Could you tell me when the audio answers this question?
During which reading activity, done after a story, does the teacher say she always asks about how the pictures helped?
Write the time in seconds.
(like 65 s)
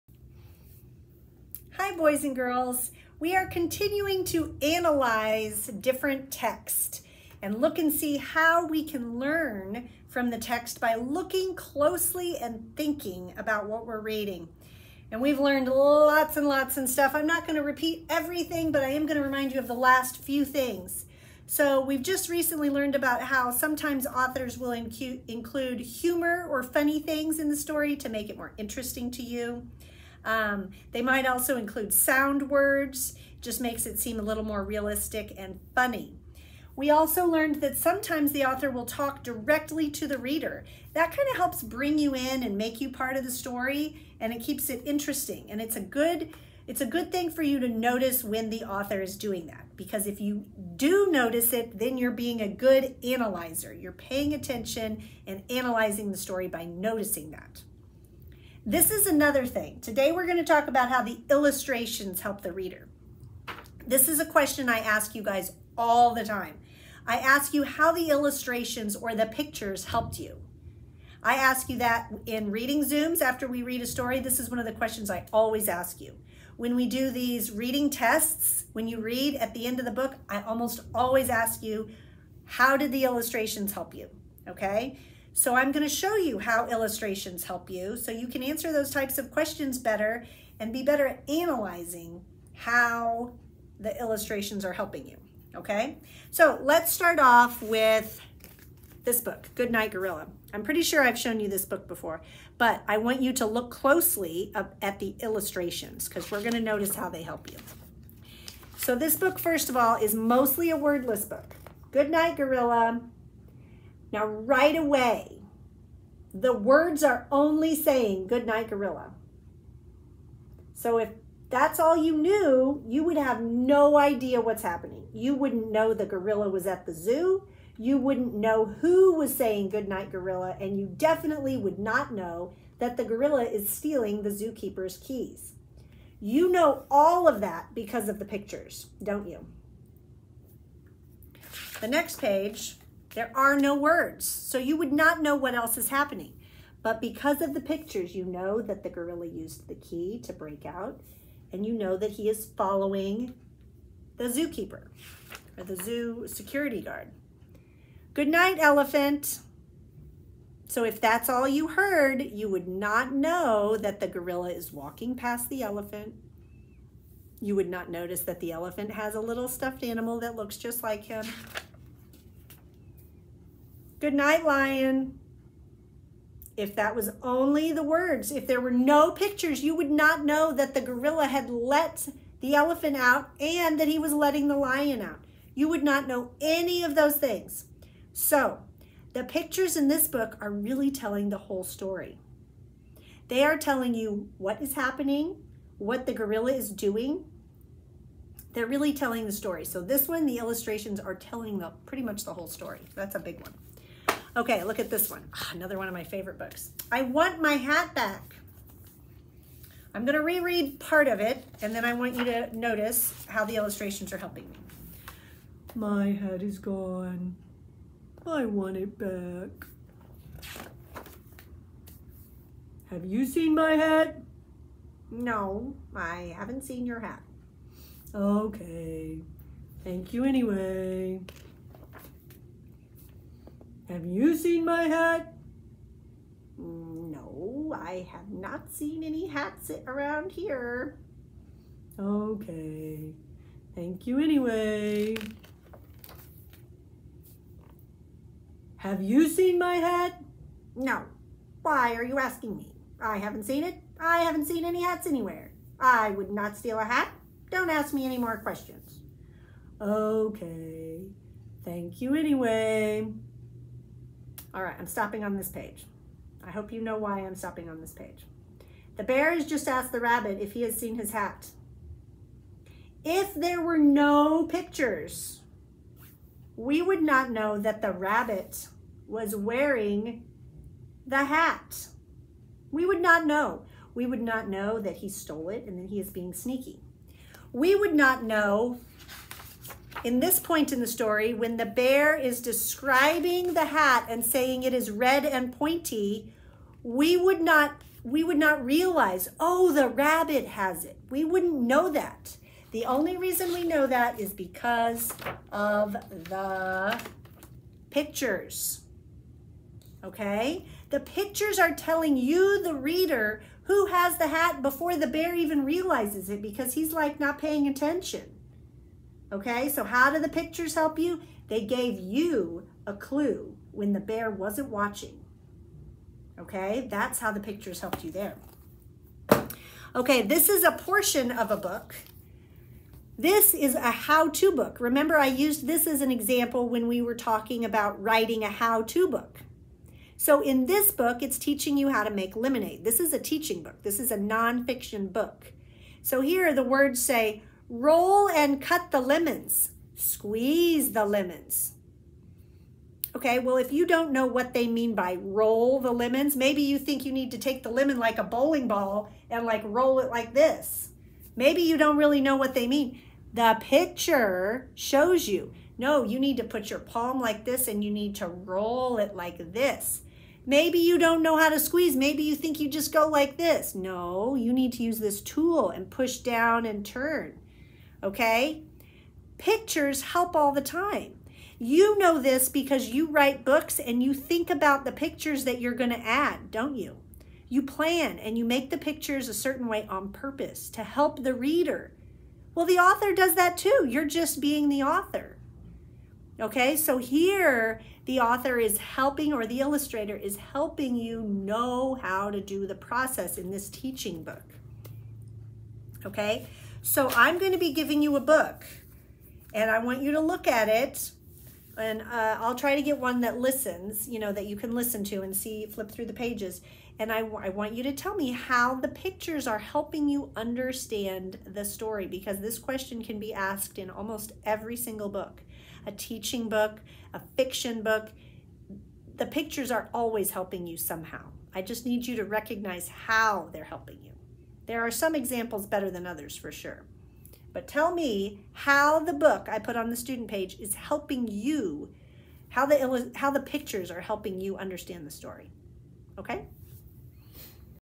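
72 s.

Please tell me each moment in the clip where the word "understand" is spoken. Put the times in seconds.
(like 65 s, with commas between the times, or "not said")
420 s, 444 s.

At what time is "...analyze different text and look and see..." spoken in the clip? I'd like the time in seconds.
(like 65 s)
4 s.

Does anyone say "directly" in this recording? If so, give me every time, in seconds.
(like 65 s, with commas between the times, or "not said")
39 s.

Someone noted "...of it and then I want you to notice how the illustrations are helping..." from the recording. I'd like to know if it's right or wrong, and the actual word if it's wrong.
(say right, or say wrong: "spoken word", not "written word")
right.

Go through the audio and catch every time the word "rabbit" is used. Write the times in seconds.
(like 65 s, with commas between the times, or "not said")
270 s, 277 s, 299 s.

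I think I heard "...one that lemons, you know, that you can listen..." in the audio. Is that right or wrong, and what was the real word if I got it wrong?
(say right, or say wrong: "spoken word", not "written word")
wrong: "listens", not "lemons".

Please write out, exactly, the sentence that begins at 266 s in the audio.
I hope you know why I'm stopping on this page.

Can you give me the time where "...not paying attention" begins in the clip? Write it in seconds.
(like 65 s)
317 s.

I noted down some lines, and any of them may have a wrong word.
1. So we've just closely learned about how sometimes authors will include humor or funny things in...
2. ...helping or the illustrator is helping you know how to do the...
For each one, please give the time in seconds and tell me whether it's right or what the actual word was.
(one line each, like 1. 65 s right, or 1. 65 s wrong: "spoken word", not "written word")
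1. 21 s wrong: "recently", not "closely"
2. 398 s right.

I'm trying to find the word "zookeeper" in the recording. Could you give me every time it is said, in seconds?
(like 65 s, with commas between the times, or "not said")
134 s, 154 s.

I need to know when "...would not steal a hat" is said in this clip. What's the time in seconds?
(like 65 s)
256 s.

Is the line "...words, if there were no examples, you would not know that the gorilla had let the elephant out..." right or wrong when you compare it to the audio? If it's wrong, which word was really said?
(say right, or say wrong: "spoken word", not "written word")
wrong: "pictures", not "examples".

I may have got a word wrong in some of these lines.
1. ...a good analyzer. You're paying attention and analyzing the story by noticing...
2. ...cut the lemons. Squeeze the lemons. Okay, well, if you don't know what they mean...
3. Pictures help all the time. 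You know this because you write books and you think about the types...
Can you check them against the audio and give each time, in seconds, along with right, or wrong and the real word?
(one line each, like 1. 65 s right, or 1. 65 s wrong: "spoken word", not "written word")
1. 52 s right
2. 348 s right
3. 379 s wrong: "pictures", not "types".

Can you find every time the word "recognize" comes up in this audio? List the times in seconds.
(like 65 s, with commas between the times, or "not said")
432 s.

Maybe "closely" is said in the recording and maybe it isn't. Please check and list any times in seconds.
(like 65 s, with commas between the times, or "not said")
11 s, 103 s.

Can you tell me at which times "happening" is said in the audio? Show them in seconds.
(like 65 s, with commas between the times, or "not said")
124 s, 145 s, 194 s.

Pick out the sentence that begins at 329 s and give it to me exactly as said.
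Okay, this is a portion of a book.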